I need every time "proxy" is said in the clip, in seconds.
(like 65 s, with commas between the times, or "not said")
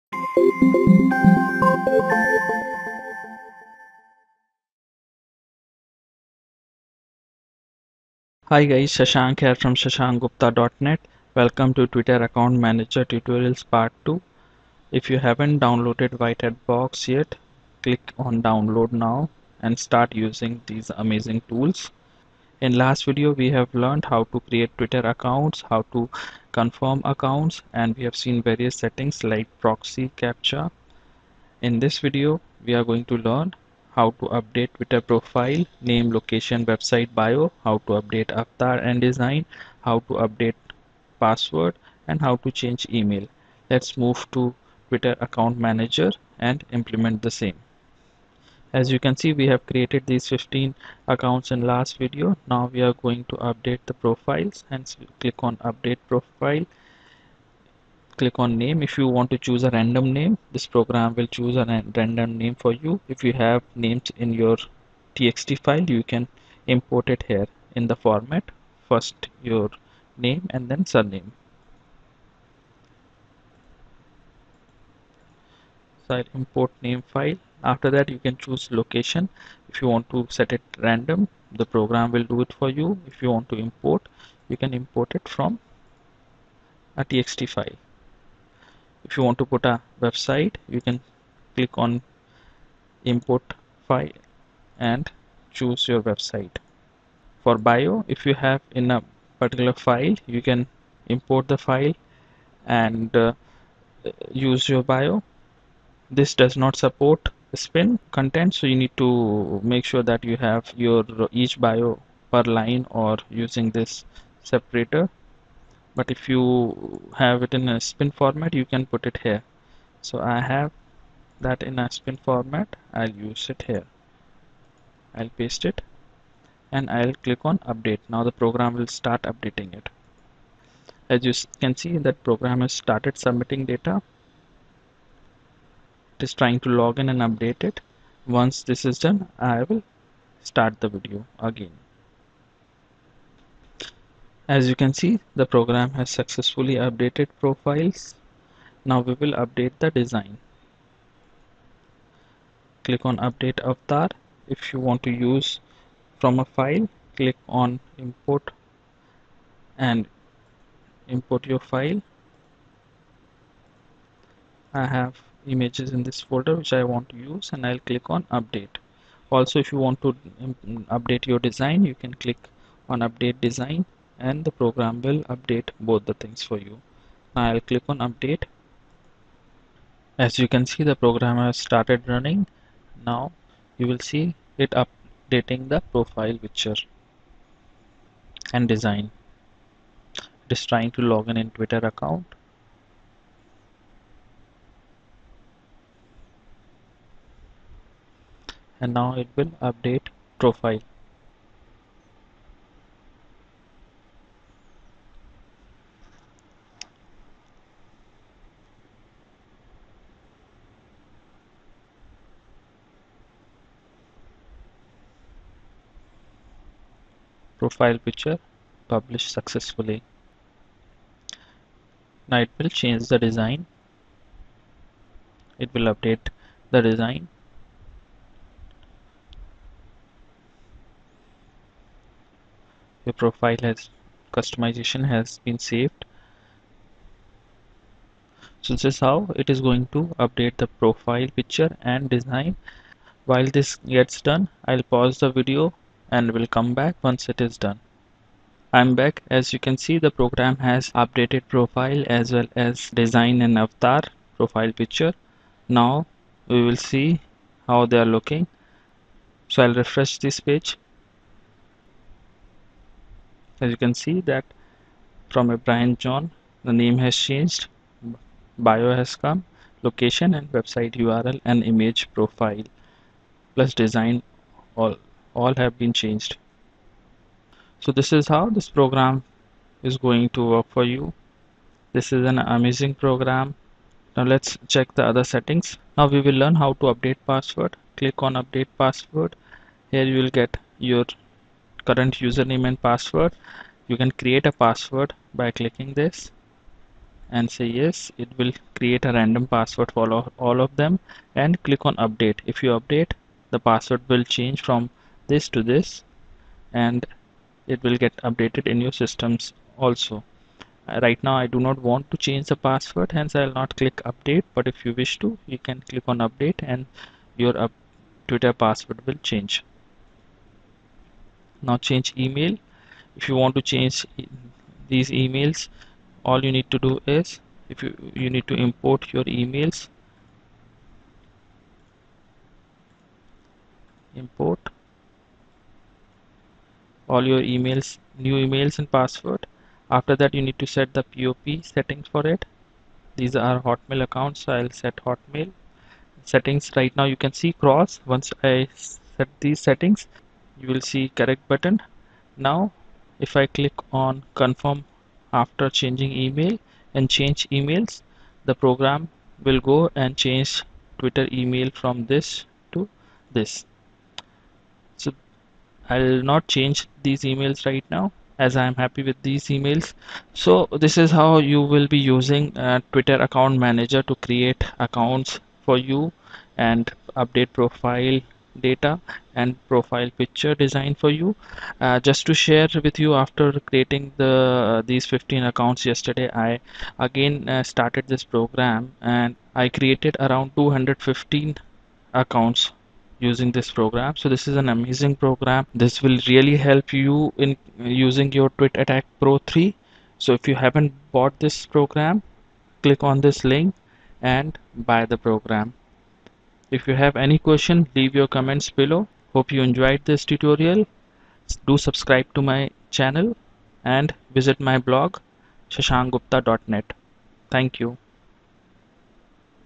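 29 s.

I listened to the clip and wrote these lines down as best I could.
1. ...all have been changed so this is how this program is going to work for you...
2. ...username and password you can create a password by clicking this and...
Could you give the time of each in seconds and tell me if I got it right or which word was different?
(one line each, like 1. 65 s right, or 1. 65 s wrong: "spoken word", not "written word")
1. 275 s right
2. 292 s right.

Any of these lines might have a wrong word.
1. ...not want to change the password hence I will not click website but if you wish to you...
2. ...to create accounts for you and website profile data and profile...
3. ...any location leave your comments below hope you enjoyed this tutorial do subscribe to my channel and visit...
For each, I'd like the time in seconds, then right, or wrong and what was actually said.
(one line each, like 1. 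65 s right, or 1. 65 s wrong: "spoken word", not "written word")
1. 311 s wrong: "update", not "website"
2. 374 s wrong: "update", not "website"
3. 407 s wrong: "question", not "location".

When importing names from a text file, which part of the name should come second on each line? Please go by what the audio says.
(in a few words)
surname.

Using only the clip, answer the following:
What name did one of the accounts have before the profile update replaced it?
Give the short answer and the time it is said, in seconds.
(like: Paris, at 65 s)
Brian John, at 265 s.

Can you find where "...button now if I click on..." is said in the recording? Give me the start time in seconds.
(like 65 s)
351 s.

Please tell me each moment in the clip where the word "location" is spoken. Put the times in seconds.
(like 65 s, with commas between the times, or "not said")
36 s, 78 s, 269 s.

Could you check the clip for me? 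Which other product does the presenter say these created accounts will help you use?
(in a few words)
Tweet Attack pro 3.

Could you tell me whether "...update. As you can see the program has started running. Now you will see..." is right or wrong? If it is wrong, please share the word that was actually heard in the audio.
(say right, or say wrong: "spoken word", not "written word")
right.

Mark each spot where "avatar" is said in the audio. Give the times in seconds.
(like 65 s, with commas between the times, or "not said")
38 s, 153 s, 253 s.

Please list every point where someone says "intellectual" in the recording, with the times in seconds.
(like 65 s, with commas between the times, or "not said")
not said.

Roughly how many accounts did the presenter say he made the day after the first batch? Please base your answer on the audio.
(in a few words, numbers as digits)
215.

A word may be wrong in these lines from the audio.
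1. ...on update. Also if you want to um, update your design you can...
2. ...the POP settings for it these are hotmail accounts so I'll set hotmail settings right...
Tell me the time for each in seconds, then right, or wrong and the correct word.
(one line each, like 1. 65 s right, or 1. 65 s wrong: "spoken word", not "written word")
1. 168 s right
2. 340 s right.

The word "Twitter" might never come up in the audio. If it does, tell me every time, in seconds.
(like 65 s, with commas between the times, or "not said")
11 s, 24 s, 34 s, 44 s, 191 s, 318 s, 361 s, 372 s.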